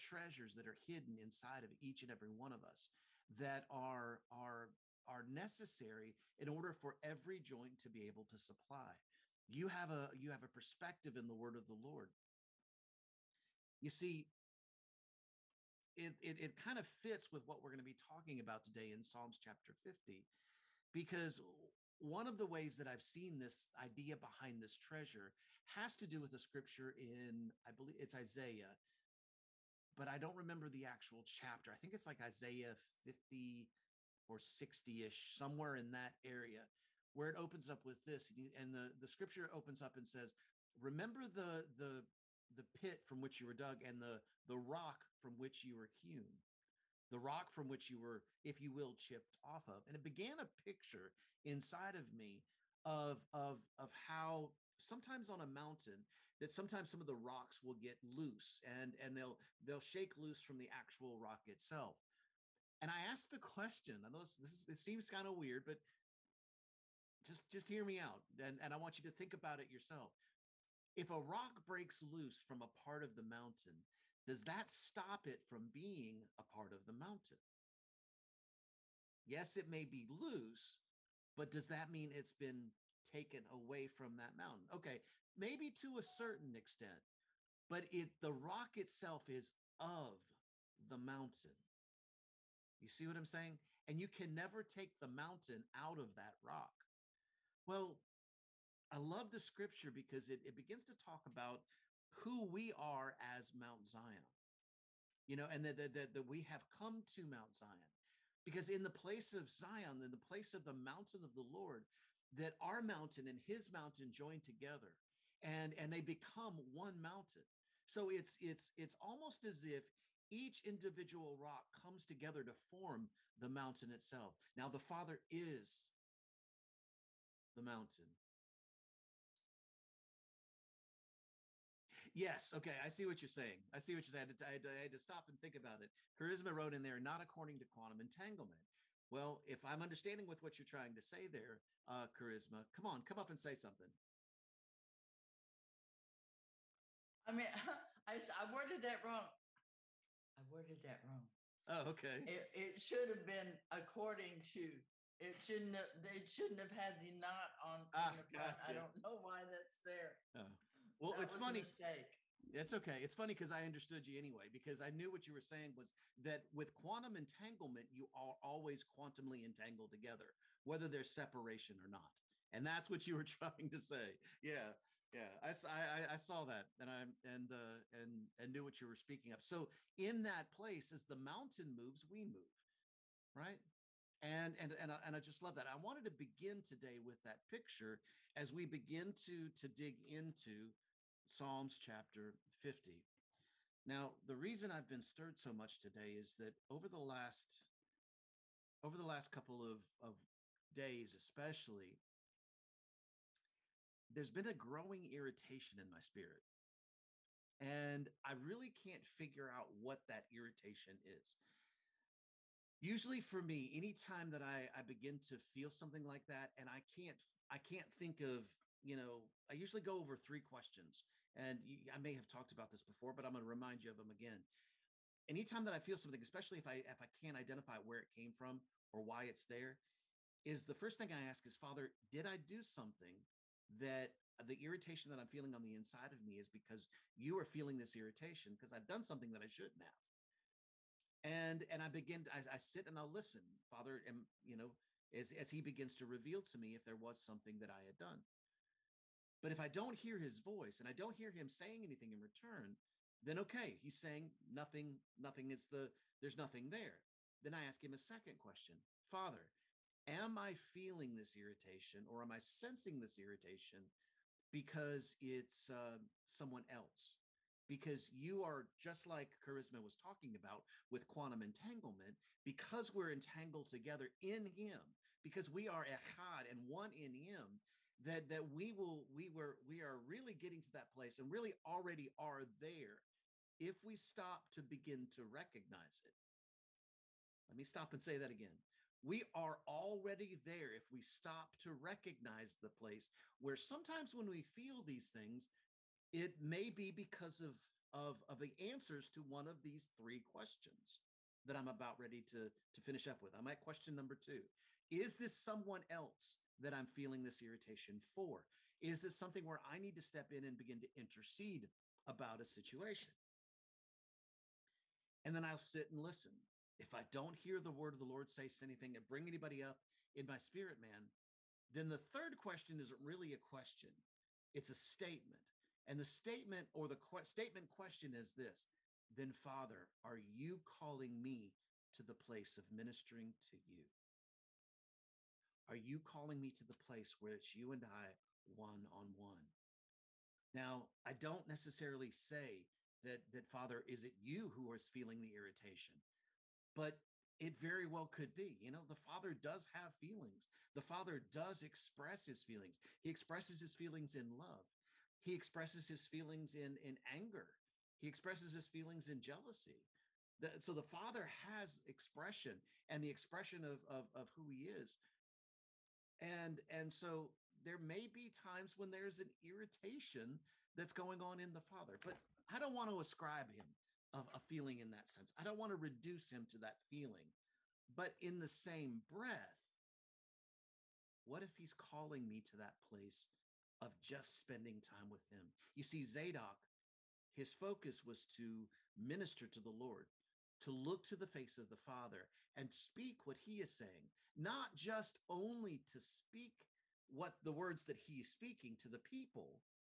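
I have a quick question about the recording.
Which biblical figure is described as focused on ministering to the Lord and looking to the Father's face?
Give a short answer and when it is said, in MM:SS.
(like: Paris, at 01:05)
Zadok, at 06:26.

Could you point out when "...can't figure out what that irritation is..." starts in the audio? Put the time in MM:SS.
03:28.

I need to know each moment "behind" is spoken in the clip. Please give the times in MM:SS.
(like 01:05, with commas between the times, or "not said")
00:24.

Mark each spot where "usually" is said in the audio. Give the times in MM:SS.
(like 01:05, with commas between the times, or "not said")
03:32, 03:39.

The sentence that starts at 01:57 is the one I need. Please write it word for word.
So it's it's it's almost as if each individual rock comes together to form the mountain itself.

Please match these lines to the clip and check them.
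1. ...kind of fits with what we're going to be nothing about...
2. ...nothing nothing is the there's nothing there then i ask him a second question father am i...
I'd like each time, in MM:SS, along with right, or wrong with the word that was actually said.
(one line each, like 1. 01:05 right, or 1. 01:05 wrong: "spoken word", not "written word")
1. 00:16 wrong: "talking", not "nothing"
2. 04:14 right.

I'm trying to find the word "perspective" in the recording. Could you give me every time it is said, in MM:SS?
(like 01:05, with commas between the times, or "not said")
00:10.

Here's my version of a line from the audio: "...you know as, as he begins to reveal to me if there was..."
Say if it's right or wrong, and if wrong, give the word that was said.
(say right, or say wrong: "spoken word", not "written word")
right.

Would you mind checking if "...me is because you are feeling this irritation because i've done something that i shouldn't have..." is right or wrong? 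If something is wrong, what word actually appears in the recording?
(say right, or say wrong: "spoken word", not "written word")
right.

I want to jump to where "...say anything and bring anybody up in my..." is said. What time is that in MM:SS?
05:18.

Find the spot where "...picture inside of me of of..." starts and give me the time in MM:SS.
00:50.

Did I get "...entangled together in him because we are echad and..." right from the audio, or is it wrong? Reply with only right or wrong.
right.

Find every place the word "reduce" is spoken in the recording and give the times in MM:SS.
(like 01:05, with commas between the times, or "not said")
06:15.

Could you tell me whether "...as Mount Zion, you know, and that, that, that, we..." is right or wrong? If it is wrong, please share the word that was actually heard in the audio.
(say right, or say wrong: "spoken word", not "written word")
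right.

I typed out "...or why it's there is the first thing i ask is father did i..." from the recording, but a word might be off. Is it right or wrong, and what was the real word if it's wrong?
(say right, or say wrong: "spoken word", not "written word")
right.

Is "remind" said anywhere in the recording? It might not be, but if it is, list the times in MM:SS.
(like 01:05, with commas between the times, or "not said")
03:43.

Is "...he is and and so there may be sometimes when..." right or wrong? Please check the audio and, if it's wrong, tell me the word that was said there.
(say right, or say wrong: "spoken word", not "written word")
wrong: "times", not "sometimes".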